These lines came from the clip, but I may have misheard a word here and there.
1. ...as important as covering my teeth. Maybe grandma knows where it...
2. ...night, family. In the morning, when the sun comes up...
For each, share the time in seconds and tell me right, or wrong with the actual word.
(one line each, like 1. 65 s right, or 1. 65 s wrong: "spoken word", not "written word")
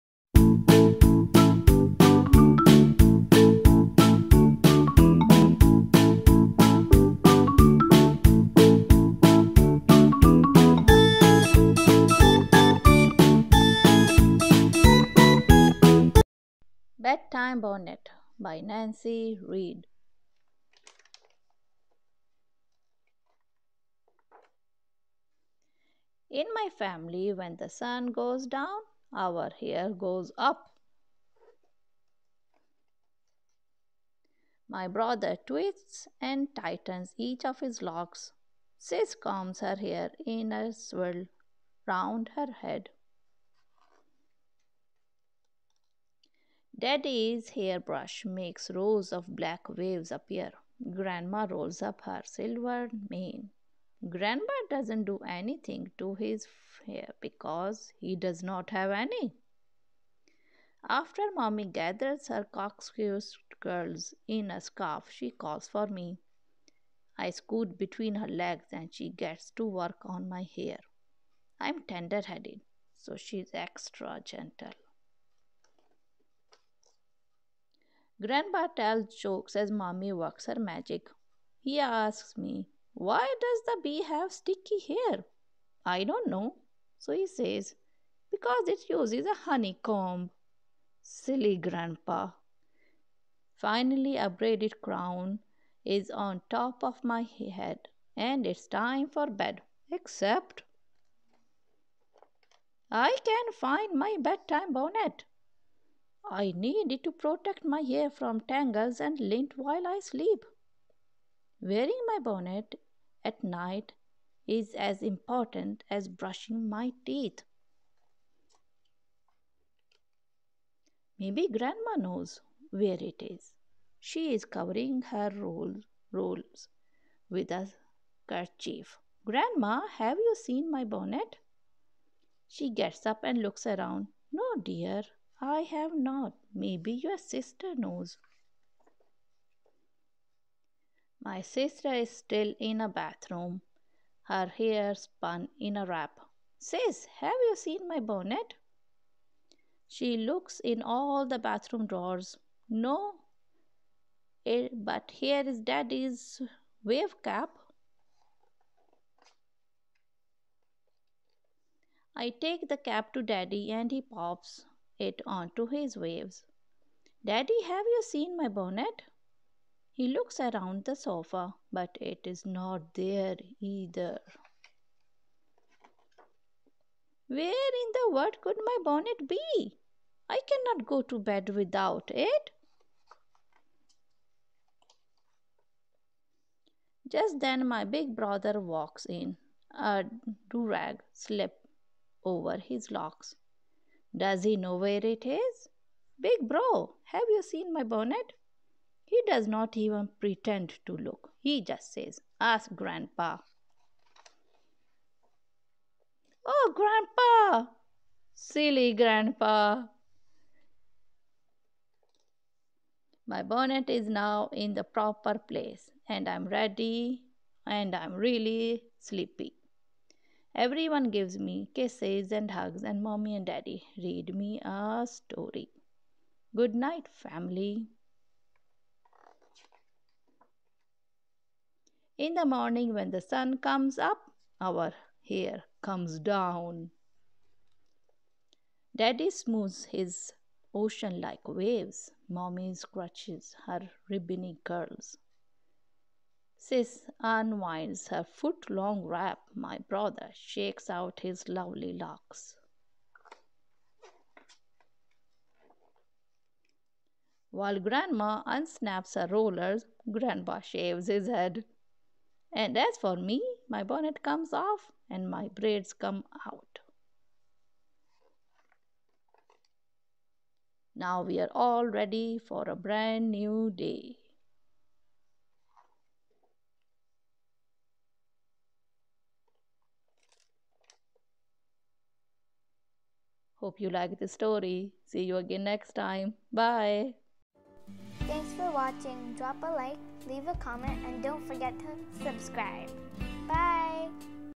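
1. 114 s wrong: "brushing", not "covering"
2. 226 s right.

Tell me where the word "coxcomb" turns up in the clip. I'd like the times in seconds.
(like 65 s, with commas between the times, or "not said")
62 s.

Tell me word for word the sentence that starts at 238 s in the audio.
Daddy smooths his ocean like waves.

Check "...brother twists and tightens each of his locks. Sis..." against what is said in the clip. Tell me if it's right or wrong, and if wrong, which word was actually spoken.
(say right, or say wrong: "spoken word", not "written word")
right.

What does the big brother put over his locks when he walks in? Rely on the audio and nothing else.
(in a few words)
A rag.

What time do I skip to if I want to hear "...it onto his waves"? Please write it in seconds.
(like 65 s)
164 s.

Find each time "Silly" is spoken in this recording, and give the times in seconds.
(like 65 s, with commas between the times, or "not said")
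91 s, 208 s.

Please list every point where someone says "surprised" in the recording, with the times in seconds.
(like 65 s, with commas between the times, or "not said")
not said.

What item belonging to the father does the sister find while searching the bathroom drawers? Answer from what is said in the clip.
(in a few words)
Wave cap.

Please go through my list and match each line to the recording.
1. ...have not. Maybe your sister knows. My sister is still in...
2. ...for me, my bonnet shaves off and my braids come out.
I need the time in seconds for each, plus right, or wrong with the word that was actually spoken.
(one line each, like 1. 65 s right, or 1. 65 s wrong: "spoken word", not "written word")
1. 135 s right
2. 262 s wrong: "comes", not "shaves".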